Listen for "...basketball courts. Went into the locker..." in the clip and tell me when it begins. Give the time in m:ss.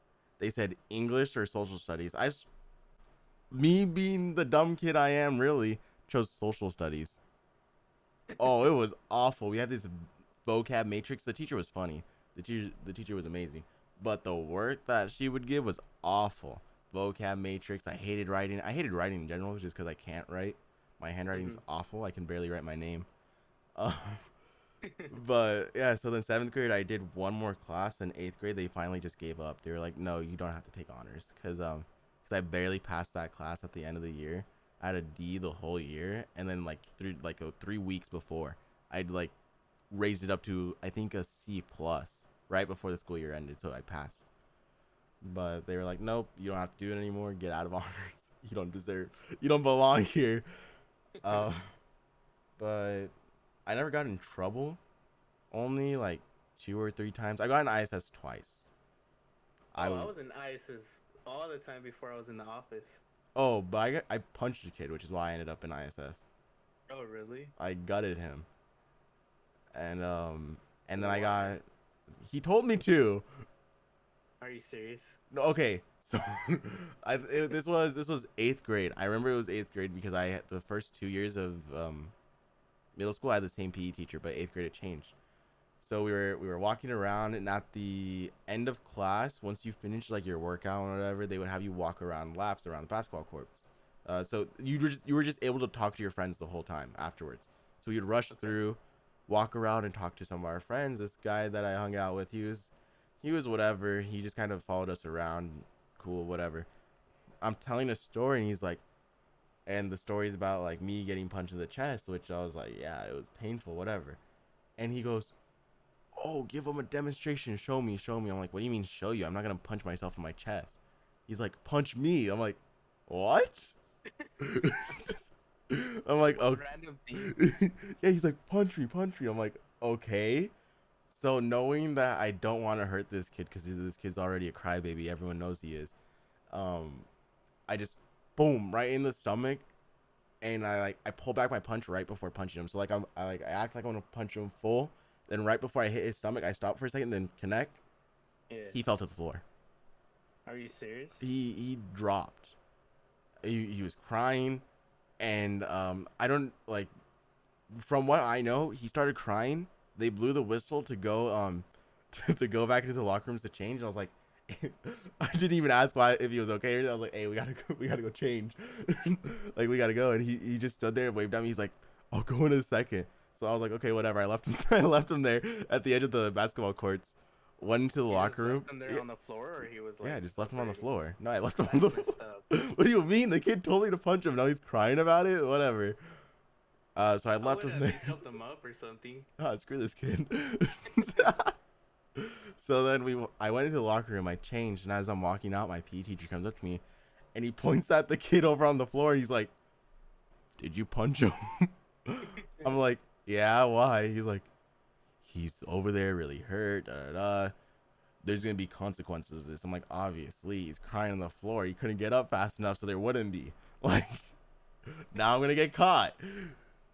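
2:56.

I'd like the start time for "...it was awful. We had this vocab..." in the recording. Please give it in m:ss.
0:08.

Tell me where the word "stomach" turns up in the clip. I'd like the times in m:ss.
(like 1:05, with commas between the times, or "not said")
2:19, 2:26.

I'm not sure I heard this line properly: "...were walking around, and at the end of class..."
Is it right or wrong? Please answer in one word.
right.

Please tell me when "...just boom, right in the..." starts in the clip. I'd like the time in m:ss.
2:17.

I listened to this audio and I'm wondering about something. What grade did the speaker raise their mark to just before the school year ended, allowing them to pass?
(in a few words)
C plus.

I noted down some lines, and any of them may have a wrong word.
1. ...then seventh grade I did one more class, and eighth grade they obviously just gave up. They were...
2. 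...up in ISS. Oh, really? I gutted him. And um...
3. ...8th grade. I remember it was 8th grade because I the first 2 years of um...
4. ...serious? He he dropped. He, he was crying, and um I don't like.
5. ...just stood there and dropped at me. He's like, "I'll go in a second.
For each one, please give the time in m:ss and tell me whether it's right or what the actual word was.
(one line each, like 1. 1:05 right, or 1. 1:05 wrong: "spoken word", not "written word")
1. 0:26 wrong: "finally", not "obviously"
2. 1:05 right
3. 1:18 right
4. 2:30 right
5. 2:50 wrong: "waved", not "dropped".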